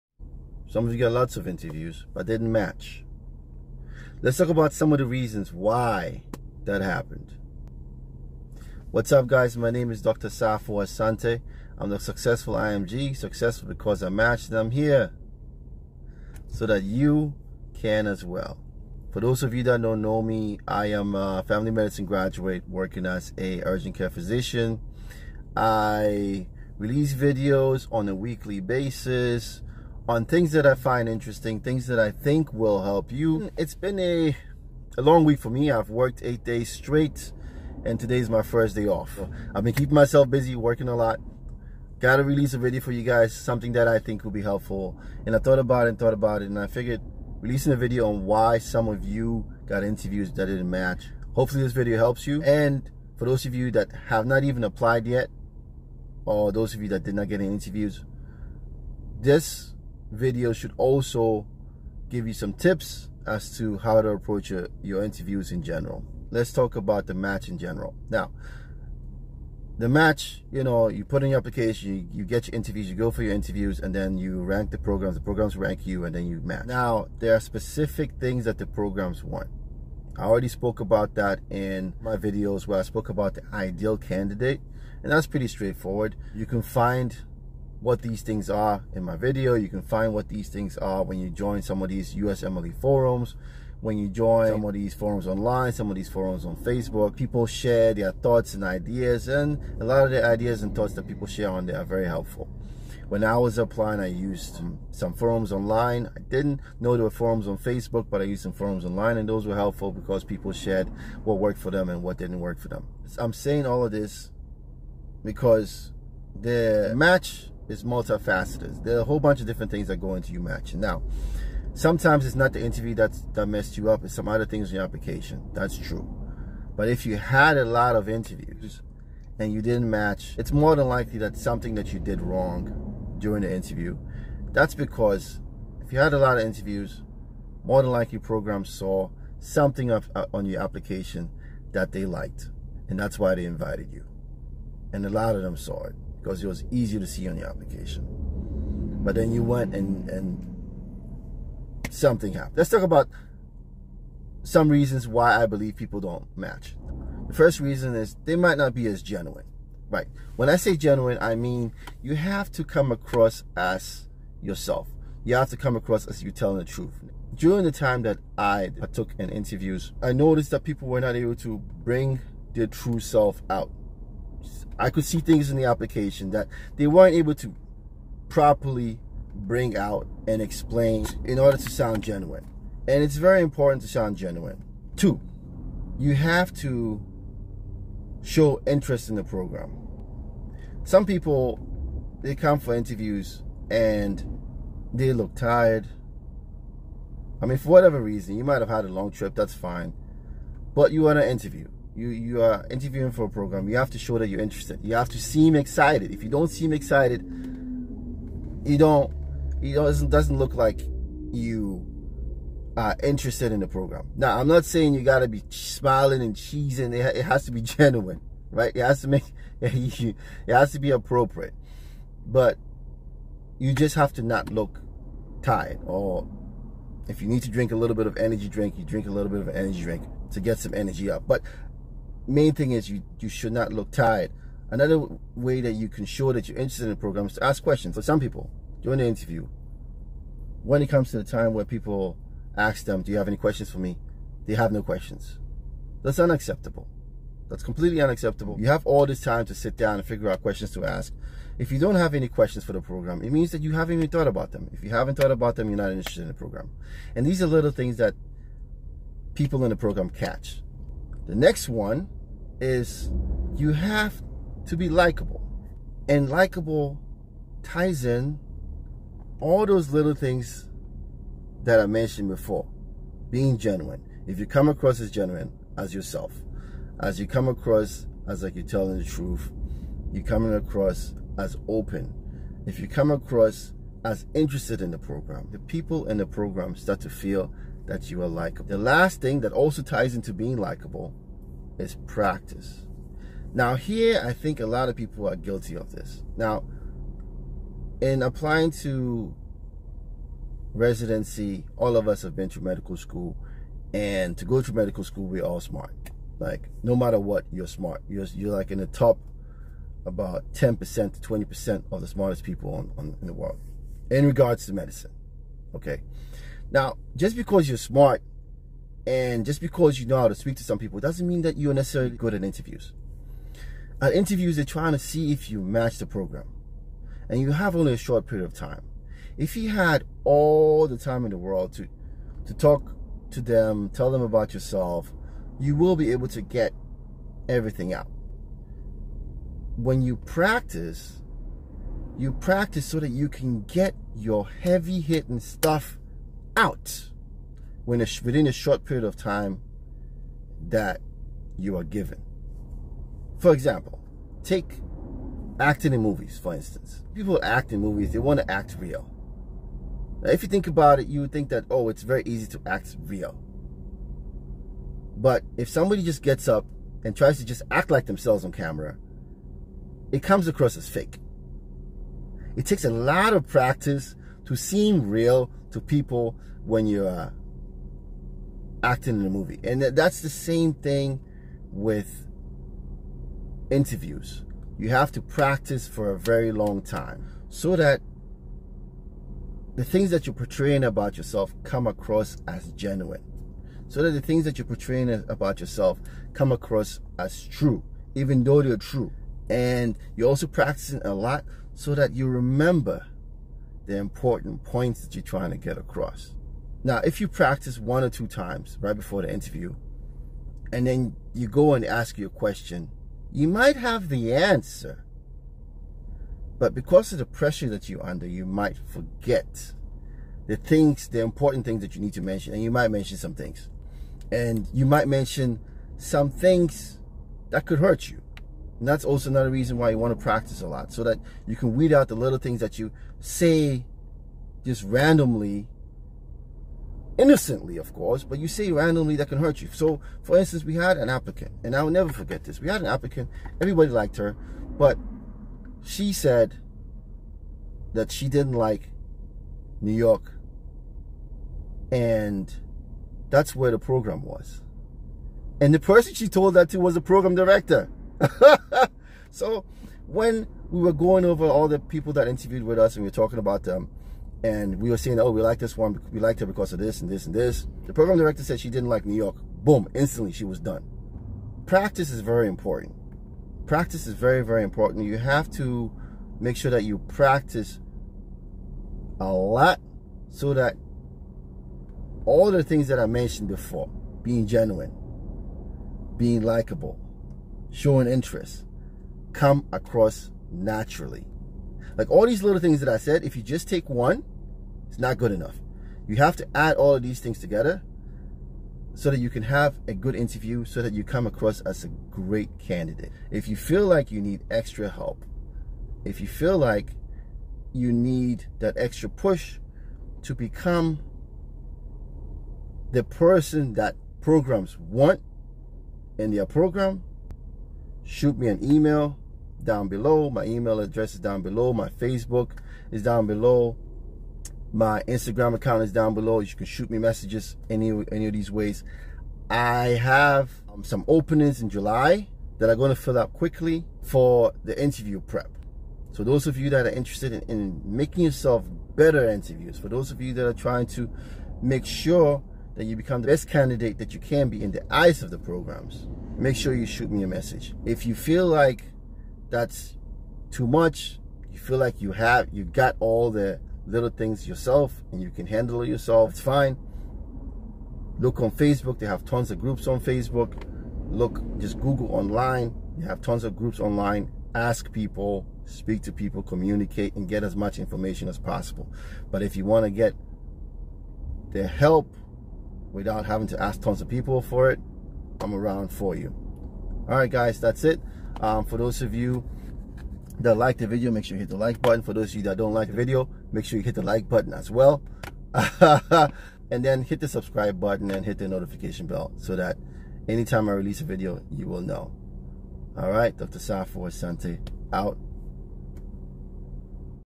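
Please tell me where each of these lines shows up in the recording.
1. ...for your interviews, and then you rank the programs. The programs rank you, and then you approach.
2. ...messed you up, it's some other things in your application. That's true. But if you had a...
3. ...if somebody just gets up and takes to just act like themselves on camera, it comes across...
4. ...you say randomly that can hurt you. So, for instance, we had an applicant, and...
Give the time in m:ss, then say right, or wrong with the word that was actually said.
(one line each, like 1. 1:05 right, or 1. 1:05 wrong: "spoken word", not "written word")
1. 1:13 wrong: "match", not "approach"
2. 2:03 right
3. 6:05 wrong: "tries", not "takes"
4. 7:18 right.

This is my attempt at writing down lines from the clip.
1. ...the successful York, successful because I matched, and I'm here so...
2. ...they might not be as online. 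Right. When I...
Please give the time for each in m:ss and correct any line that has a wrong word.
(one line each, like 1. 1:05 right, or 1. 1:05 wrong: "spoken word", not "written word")
1. 0:11 wrong: "IMG", not "York"
2. 2:38 wrong: "genuine", not "online".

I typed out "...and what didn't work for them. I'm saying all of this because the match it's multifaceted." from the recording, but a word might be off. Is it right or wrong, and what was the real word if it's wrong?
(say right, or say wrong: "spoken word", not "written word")
right.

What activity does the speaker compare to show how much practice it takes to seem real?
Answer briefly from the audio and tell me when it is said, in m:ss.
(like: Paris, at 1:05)
Acting in movies, at 5:55.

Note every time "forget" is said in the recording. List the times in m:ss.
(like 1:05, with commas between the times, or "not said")
6:58, 7:22.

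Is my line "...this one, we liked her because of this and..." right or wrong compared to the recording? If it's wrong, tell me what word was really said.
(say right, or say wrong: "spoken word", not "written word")
right.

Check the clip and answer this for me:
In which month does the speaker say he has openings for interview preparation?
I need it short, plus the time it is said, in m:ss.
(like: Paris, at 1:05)
July, at 8:51.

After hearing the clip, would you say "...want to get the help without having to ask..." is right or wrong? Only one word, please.
right.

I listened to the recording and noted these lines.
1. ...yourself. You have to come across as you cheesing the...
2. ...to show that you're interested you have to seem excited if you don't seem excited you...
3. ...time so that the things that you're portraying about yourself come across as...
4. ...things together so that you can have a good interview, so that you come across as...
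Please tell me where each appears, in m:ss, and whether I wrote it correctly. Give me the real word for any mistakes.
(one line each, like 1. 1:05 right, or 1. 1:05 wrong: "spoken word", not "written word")
1. 2:44 wrong: "telling", not "cheesing"
2. 3:23 right
3. 6:26 right
4. 8:17 right.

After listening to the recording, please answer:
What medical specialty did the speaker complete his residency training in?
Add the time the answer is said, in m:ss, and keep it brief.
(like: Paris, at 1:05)
Family medicine, at 0:21.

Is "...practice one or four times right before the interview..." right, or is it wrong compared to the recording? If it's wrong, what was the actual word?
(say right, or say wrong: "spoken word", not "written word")
wrong: "two", not "four".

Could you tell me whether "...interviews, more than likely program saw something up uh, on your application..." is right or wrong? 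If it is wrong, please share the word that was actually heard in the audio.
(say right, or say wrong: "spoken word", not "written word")
right.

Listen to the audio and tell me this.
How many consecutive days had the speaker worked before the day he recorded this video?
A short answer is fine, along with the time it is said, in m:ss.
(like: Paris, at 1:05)
8, at 0:36.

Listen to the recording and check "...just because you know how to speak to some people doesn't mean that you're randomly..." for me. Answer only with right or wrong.
wrong.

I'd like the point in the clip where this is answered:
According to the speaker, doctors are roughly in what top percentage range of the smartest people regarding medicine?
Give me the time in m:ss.
5:10.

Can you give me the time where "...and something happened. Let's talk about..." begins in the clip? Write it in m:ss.
2:30.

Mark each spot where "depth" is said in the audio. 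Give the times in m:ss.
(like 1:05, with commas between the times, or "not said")
not said.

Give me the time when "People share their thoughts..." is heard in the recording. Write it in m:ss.
1:37.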